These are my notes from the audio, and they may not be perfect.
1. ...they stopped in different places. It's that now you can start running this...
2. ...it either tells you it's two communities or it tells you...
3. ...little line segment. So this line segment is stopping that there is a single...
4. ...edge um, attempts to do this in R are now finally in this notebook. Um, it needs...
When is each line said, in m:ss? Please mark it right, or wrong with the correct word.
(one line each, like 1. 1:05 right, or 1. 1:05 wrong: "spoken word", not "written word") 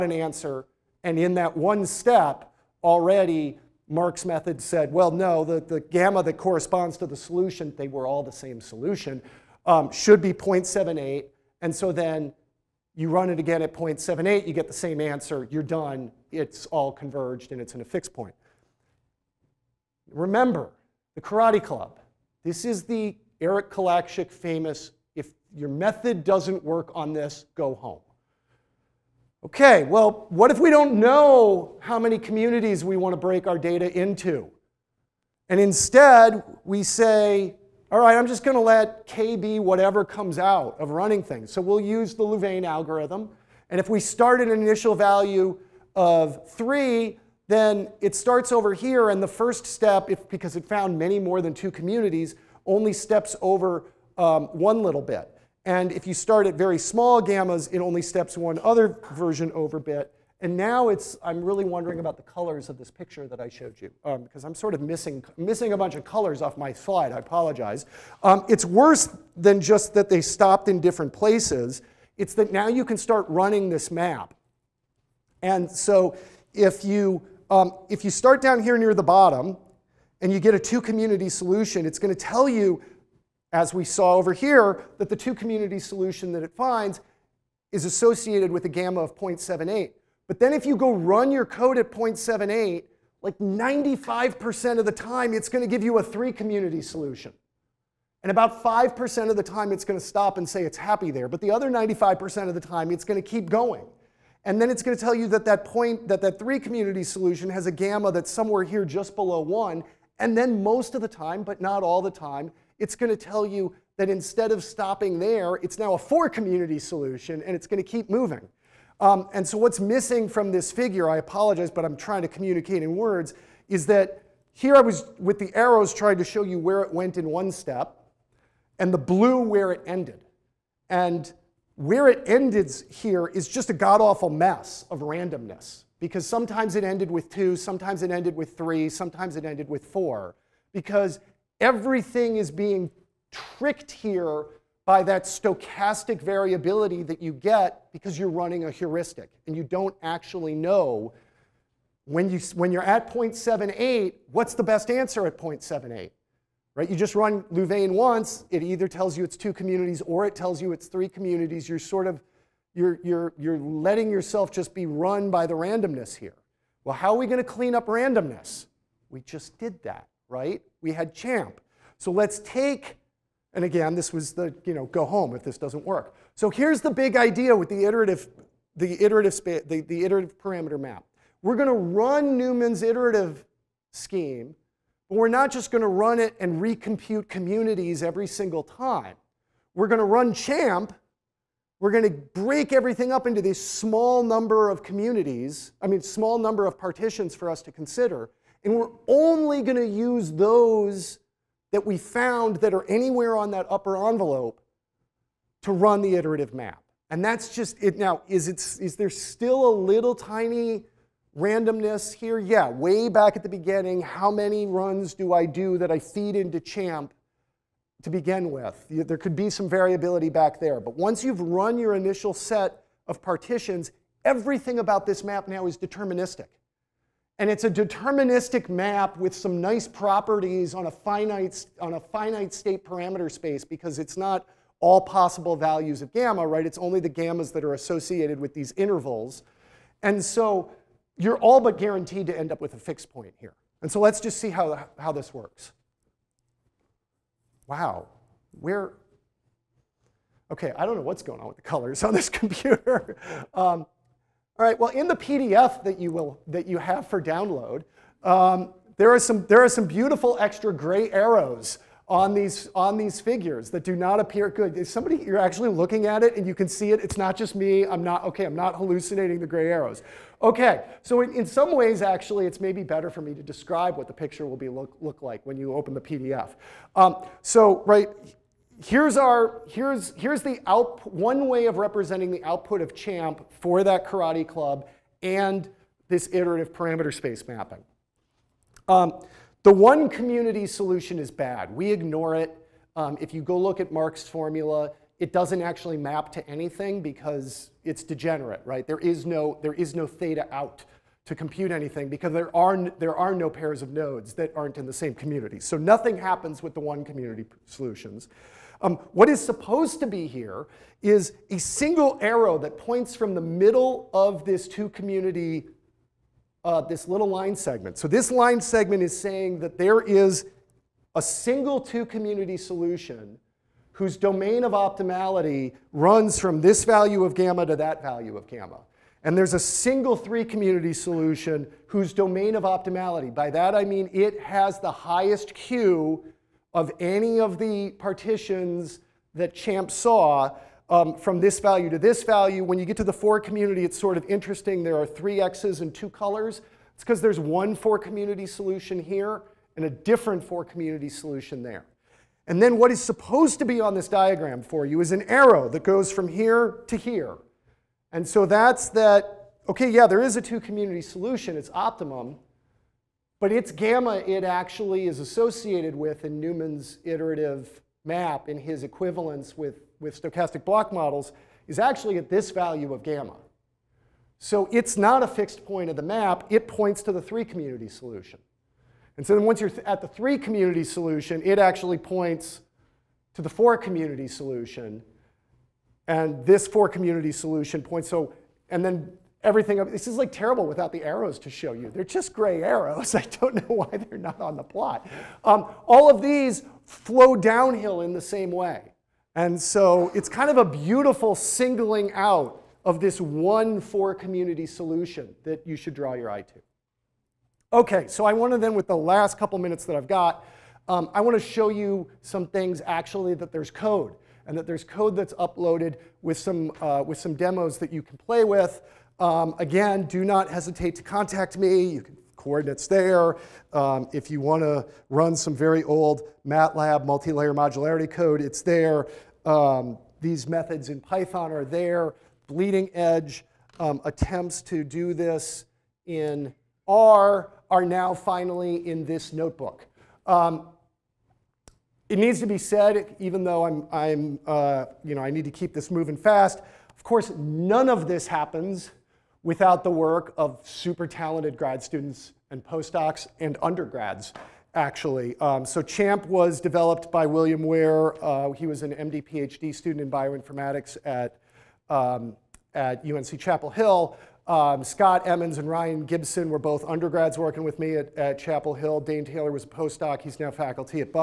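1. 1:10 right
2. 2:38 right
3. 5:17 wrong: "saying", not "stopping"
4. 7:12 right.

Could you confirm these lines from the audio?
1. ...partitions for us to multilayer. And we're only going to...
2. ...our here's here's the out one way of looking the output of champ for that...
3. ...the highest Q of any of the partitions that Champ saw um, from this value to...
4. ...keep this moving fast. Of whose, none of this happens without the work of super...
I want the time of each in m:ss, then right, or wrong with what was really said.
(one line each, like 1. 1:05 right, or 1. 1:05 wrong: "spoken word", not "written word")
1. 3:16 wrong: "consider", not "multilayer"
2. 4:39 wrong: "representing", not "looking"
3. 5:34 right
4. 7:25 wrong: "course", not "whose".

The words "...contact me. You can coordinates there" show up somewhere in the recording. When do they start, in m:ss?
7:01.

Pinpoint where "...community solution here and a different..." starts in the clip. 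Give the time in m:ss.
5:47.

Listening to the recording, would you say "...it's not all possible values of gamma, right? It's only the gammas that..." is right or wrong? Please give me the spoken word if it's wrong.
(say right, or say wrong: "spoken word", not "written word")
right.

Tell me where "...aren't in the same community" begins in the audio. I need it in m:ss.
5:04.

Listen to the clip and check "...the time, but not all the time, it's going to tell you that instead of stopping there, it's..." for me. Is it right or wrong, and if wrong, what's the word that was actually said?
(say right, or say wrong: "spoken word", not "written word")
right.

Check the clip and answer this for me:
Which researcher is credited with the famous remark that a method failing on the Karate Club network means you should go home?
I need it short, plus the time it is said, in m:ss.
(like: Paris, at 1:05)
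Eric Kolaczyk, at 0:23.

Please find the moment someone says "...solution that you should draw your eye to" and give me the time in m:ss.
6:44.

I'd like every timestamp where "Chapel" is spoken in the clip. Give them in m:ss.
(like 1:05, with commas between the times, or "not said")
7:43, 7:48.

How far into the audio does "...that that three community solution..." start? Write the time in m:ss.
1:46.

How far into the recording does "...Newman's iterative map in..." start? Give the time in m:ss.
6:06.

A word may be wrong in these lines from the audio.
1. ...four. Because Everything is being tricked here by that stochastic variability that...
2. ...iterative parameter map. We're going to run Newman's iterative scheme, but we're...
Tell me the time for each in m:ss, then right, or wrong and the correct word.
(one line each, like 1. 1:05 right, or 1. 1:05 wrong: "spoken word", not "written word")
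1. 2:19 right
2. 3:00 right.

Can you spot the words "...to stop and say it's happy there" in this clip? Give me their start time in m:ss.
1:39.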